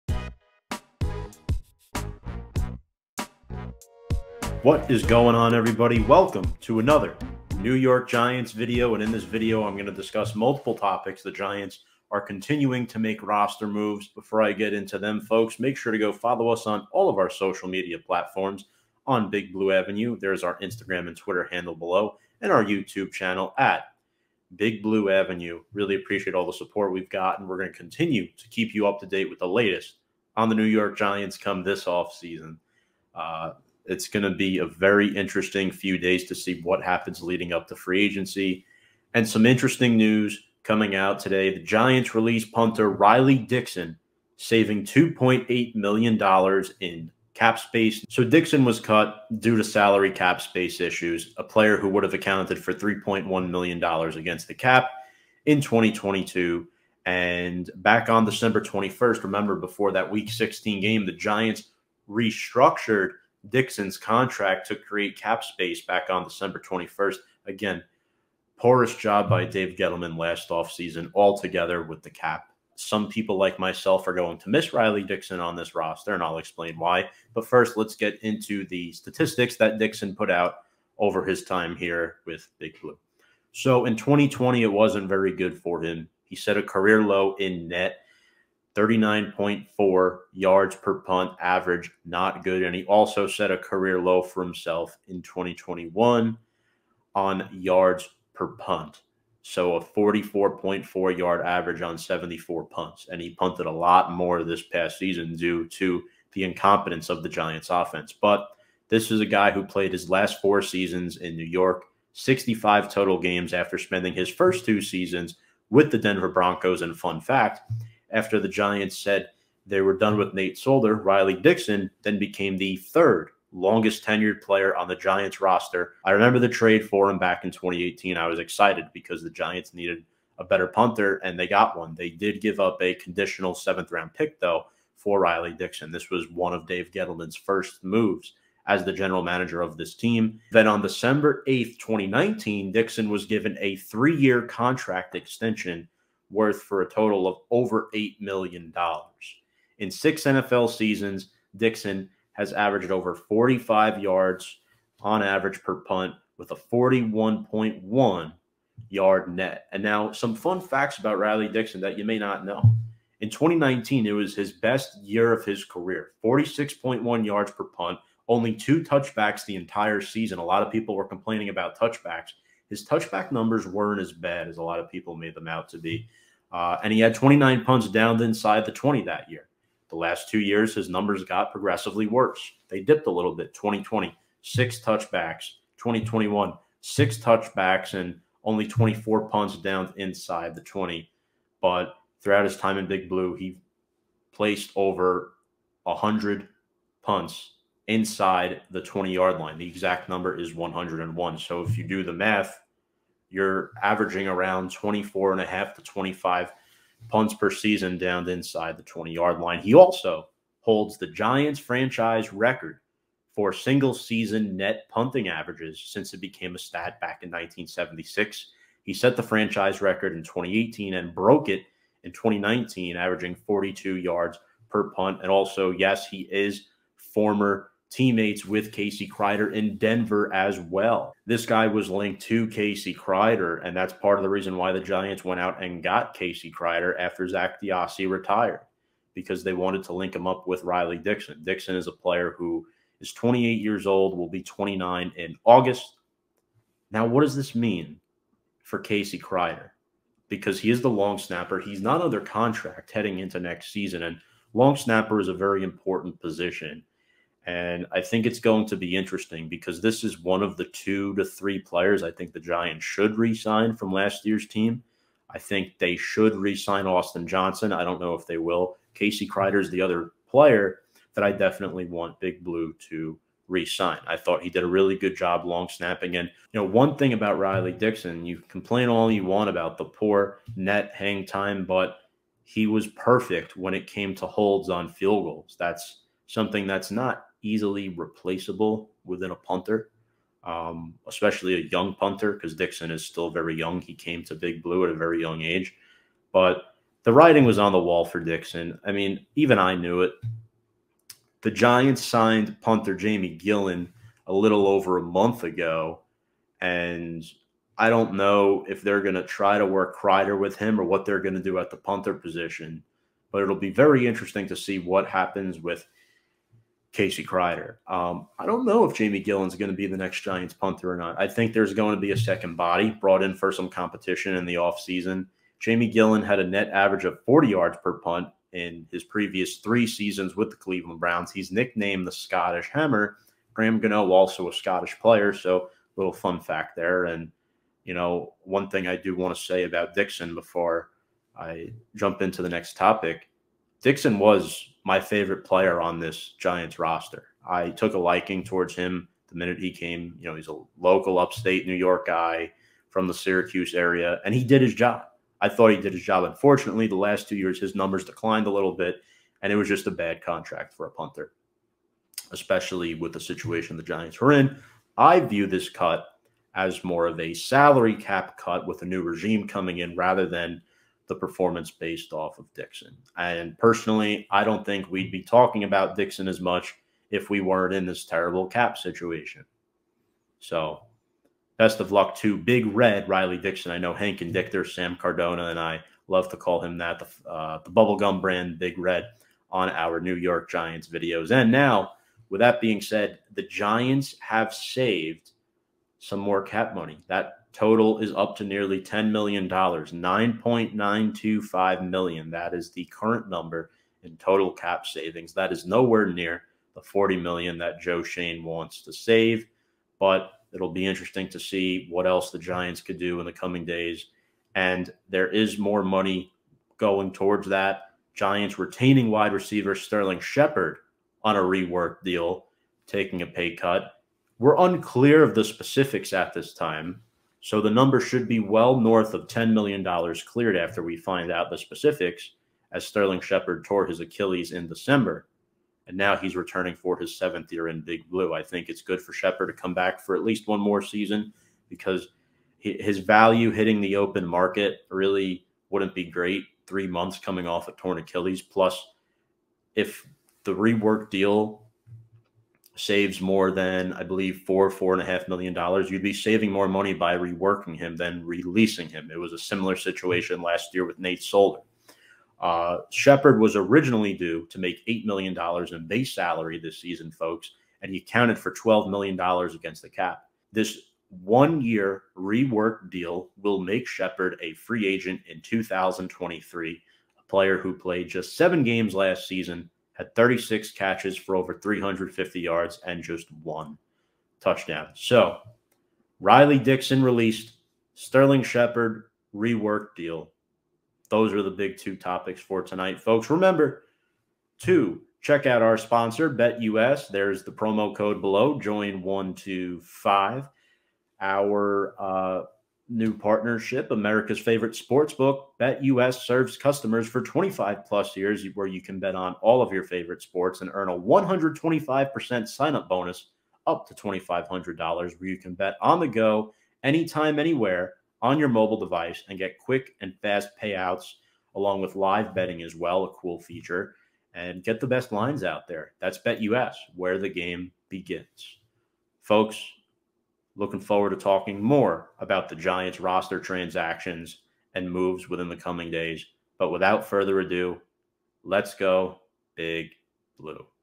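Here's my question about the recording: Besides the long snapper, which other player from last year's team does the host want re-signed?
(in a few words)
Austin Johnson.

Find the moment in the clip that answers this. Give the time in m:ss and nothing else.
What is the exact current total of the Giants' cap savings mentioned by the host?
6:39.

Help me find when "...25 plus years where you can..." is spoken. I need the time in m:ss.
8:27.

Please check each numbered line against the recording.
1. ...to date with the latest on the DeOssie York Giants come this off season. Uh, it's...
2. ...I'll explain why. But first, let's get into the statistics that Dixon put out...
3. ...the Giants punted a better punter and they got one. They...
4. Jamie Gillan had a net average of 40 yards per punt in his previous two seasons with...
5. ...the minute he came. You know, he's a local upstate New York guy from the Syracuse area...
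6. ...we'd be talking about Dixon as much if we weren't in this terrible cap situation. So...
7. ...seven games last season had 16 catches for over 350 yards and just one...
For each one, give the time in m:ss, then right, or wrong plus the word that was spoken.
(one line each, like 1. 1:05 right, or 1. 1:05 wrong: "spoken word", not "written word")
1. 0:28 wrong: "New", not "DeOssie"
2. 1:16 right
3. 2:09 wrong: "needed", not "punted"
4. 5:25 wrong: "three", not "two"
5. 5:49 right
6. 6:14 right
7. 7:58 wrong: "36", not "16".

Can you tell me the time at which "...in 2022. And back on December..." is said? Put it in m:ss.
0:55.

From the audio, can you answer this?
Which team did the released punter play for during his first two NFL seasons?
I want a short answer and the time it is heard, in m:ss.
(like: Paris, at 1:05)
Denver Broncos, at 1:55.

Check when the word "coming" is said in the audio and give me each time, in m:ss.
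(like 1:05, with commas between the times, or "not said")
0:40, 6:09, 6:53, 7:27, 8:55.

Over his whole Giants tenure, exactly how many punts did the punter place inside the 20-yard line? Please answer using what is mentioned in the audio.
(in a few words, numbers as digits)
101.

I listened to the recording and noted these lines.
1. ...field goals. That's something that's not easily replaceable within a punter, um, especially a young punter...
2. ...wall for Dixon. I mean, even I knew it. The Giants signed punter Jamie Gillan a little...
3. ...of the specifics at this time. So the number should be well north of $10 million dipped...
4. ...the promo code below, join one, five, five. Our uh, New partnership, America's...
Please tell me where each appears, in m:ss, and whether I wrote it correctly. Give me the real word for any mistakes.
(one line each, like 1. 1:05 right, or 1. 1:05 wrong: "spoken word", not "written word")
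1. 4:44 right
2. 4:57 right
3. 7:05 wrong: "cleared", not "dipped"
4. 8:17 wrong: "two", not "five".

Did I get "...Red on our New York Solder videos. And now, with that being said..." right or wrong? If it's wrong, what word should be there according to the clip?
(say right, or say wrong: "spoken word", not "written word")
wrong: "Giants", not "Solder".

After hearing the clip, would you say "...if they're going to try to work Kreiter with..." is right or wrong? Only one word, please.
right.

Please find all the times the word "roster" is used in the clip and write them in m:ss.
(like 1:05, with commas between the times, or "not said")
0:13, 1:15, 2:05, 5:46, 8:52.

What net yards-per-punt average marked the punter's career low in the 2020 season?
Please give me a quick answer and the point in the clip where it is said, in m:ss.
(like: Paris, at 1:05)
39.4, at 1:28.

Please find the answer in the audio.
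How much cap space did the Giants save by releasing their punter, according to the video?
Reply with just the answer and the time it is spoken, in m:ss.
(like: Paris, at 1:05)
$2.8 million, at 0:44.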